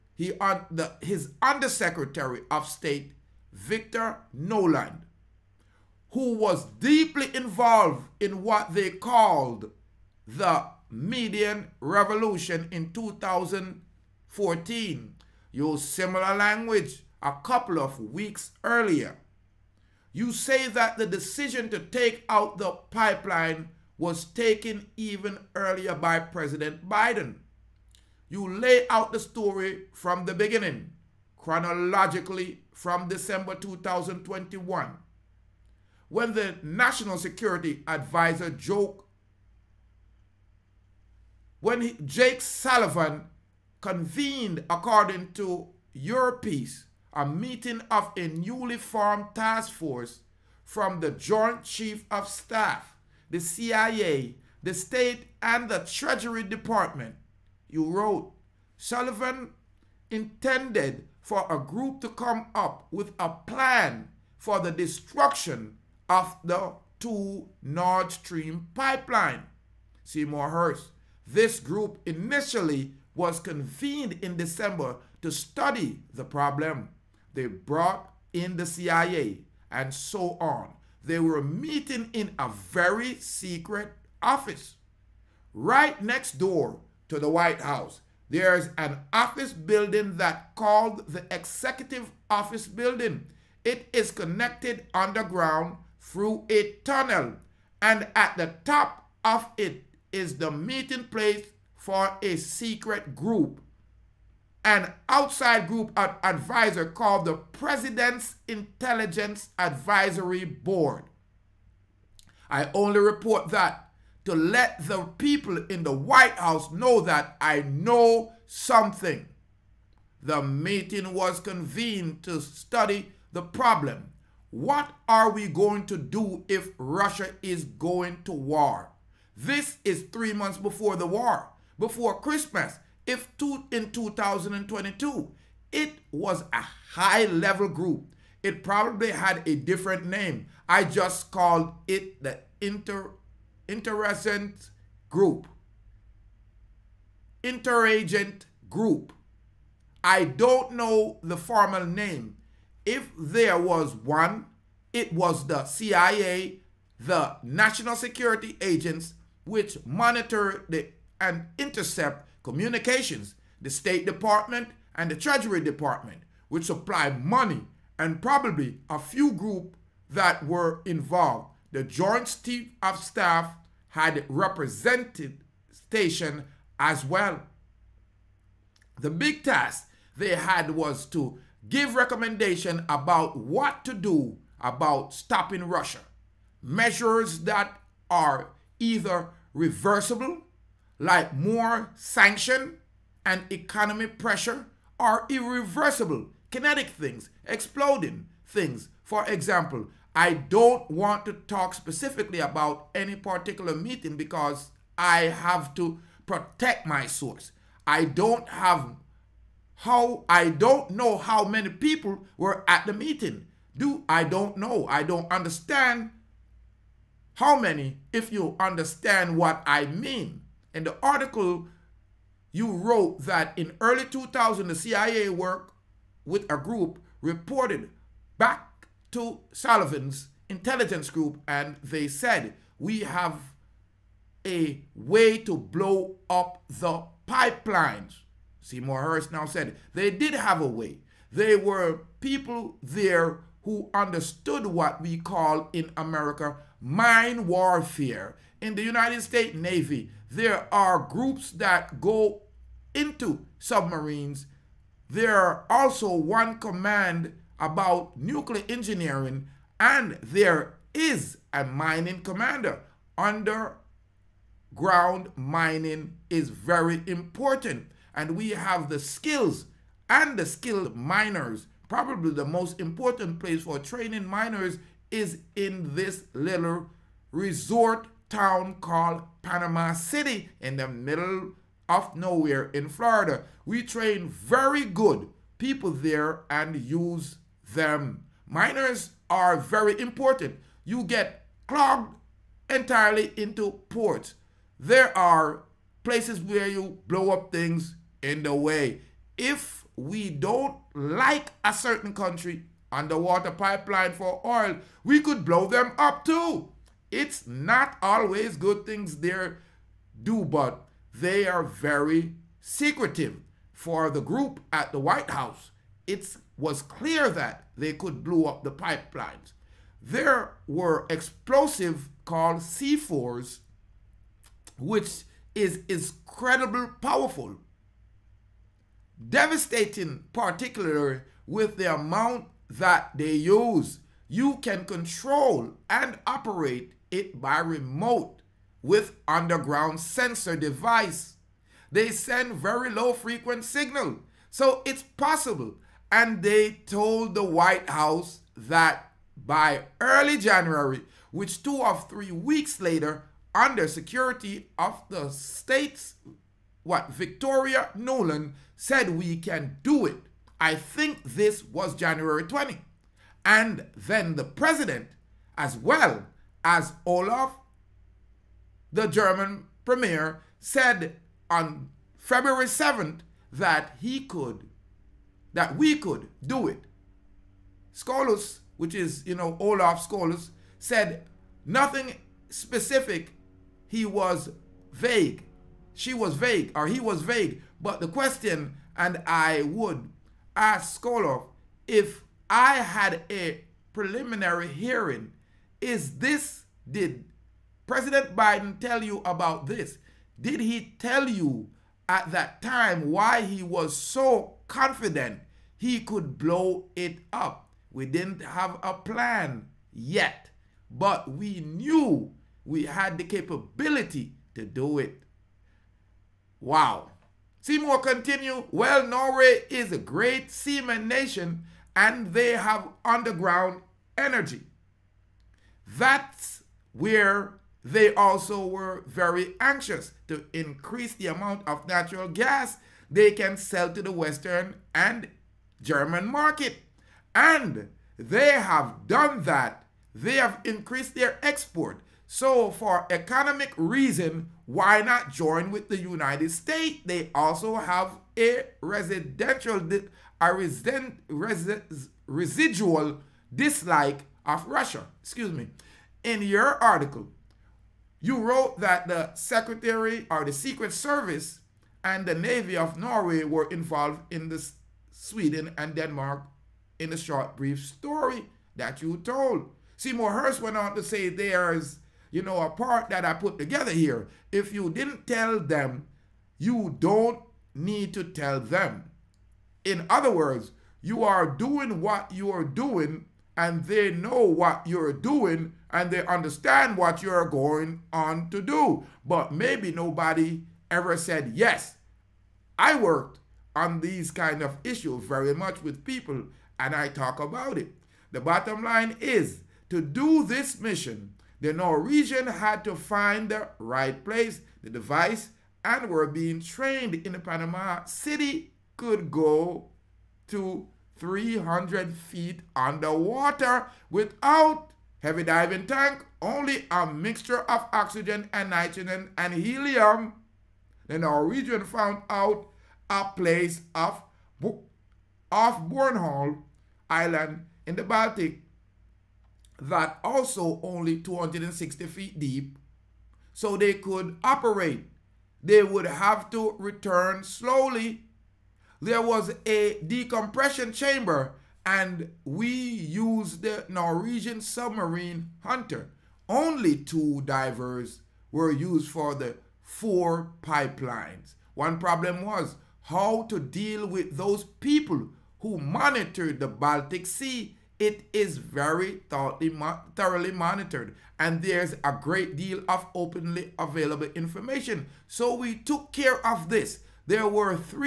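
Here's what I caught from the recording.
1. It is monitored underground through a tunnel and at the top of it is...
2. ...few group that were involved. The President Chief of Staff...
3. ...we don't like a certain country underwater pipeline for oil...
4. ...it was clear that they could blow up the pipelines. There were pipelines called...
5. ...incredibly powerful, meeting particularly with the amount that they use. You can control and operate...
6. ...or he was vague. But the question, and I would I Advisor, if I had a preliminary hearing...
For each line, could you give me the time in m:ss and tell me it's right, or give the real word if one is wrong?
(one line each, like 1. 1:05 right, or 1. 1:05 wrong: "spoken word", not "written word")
1. 1:33 wrong: "connected", not "monitored"
2. 2:48 wrong: "Joint", not "President"
3. 4:59 right
4. 5:16 wrong: "explosives", not "pipelines"
5. 5:25 wrong: "devastating", not "meeting"
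6. 6:26 wrong: "Skoloff", not "Advisor".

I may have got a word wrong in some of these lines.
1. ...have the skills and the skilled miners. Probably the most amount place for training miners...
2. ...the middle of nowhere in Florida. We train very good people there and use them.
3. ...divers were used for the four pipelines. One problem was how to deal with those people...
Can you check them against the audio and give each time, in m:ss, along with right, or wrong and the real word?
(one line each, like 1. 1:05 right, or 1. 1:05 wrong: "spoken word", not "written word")
1. 4:28 wrong: "important", not "amount"
2. 4:40 right
3. 9:07 right.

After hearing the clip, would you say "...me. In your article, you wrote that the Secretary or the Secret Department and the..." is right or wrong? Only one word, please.
wrong.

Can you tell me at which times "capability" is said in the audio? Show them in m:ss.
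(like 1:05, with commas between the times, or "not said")
6:53.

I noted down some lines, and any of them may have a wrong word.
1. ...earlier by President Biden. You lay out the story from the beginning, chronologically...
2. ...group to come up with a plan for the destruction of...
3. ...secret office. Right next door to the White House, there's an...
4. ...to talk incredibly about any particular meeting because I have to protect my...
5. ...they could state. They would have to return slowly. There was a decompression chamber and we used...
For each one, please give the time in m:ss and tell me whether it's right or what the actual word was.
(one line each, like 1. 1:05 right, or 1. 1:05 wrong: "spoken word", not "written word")
1. 0:25 right
2. 1:01 right
3. 1:23 right
4. 3:21 wrong: "specifically", not "incredibly"
5. 8:53 wrong: "operate", not "state".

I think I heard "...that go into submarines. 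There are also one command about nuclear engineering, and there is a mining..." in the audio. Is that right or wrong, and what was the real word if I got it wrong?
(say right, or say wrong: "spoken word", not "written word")
right.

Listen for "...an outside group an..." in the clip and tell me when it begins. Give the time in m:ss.
1:44.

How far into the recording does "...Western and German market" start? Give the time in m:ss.
7:14.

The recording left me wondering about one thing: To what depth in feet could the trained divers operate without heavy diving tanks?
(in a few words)
300 feet.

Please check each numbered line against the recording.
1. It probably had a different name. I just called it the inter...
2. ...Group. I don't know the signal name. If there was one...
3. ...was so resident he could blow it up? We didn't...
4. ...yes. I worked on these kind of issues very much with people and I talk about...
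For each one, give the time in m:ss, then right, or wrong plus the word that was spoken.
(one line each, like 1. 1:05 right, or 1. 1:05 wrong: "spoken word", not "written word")
1. 2:18 right
2. 2:28 wrong: "formal", not "signal"
3. 6:43 wrong: "confident", not "resident"
4. 8:11 right.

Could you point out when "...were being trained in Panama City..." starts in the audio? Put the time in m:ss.
8:26.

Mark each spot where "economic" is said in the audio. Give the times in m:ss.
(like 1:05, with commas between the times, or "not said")
3:13, 7:23.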